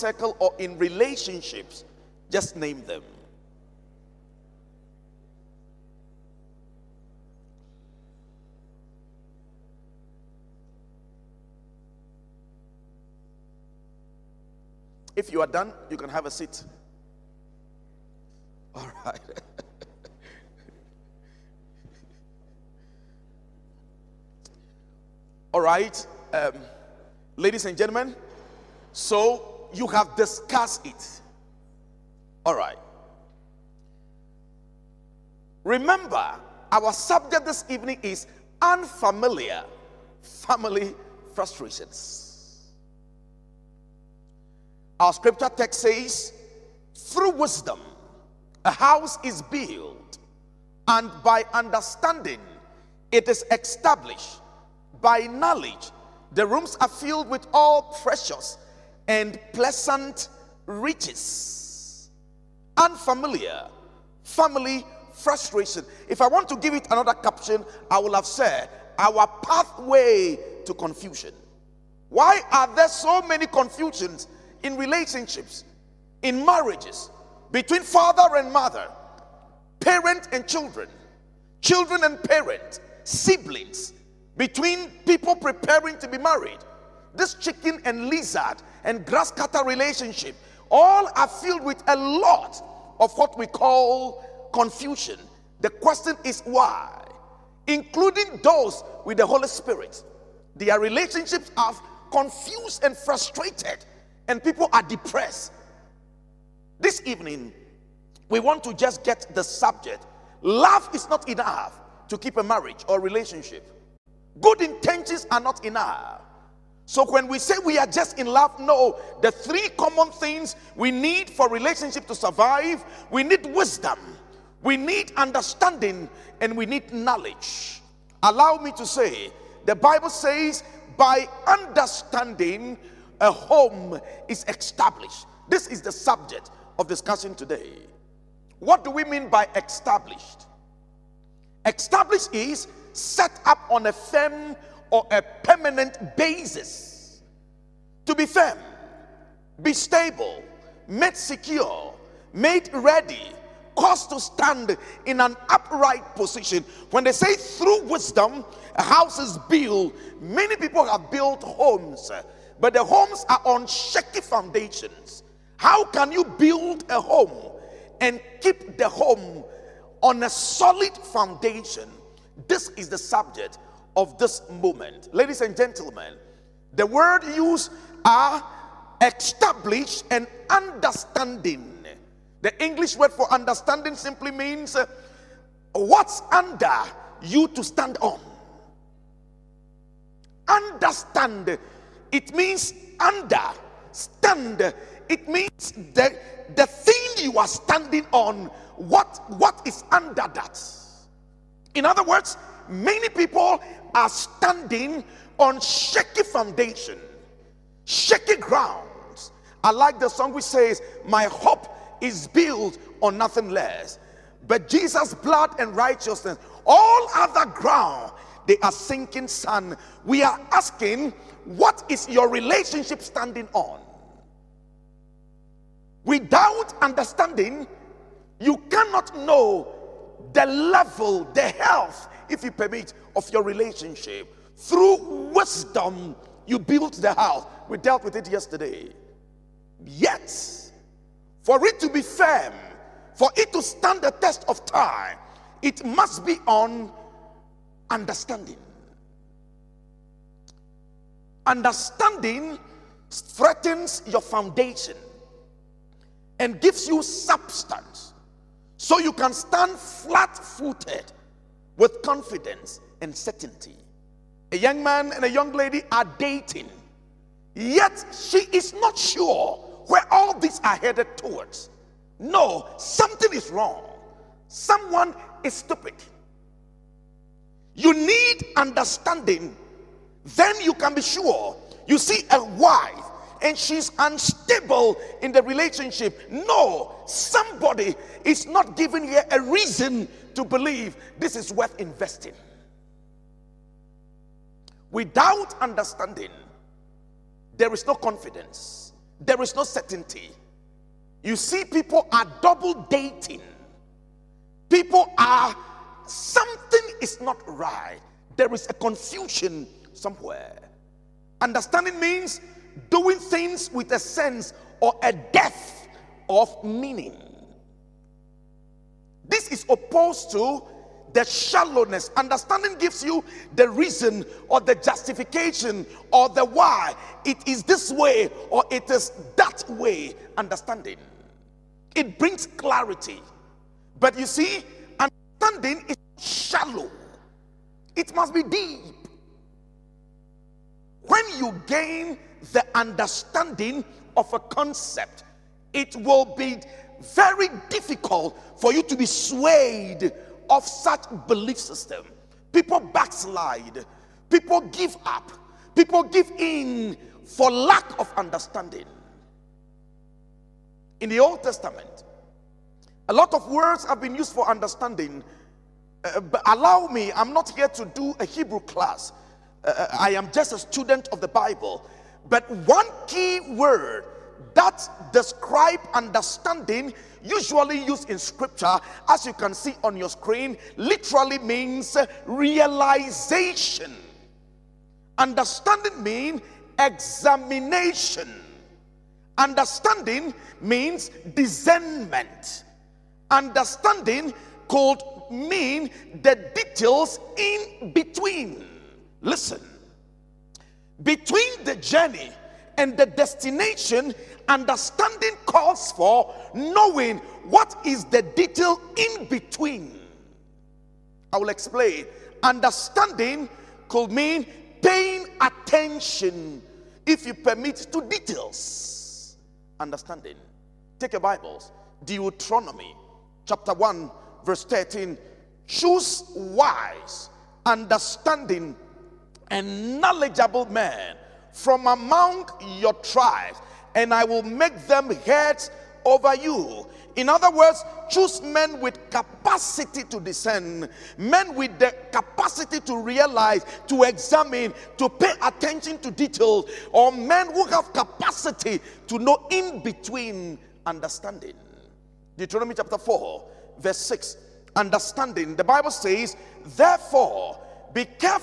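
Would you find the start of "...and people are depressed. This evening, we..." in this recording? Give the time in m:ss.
1:44.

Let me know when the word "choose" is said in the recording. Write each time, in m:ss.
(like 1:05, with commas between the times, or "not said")
7:05, 7:18.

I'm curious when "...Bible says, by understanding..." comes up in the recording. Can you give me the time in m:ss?
2:09.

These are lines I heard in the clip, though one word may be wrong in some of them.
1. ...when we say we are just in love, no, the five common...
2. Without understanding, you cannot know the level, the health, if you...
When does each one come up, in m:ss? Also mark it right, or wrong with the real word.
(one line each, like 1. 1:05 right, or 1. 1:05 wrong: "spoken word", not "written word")
1. 1:57 wrong: "three", not "five"
2. 3:46 right.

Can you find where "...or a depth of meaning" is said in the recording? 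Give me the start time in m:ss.
5:14.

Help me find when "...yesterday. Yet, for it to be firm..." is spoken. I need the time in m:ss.
3:58.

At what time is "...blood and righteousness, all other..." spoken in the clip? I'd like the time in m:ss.
3:35.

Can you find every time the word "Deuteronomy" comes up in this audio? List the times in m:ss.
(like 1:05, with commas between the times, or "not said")
7:02, 7:32.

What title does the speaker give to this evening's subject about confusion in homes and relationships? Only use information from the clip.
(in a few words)
Unfamiliar family frustrations.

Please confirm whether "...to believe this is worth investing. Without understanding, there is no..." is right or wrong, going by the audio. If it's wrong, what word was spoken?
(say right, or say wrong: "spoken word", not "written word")
right.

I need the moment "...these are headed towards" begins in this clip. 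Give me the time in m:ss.
4:30.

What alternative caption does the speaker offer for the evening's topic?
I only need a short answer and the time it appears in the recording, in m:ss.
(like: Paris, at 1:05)
Our pathway to confusion, at 1:08.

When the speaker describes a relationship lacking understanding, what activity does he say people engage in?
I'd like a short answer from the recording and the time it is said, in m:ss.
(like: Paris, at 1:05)
Double dating, at 5:02.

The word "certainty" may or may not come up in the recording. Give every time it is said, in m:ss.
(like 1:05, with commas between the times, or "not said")
4:23, 4:59.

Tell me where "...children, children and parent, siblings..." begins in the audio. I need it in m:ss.
1:20.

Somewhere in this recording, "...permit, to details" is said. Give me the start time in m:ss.
6:57.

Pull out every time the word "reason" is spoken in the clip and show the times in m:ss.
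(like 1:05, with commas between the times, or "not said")
4:49, 5:23.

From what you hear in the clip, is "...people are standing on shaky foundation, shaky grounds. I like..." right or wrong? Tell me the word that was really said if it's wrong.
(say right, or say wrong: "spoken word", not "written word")
right.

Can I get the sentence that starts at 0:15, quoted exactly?
If you are done, you can have a seat.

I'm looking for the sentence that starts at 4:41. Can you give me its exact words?
You see a wife and she's unstable in the relationship.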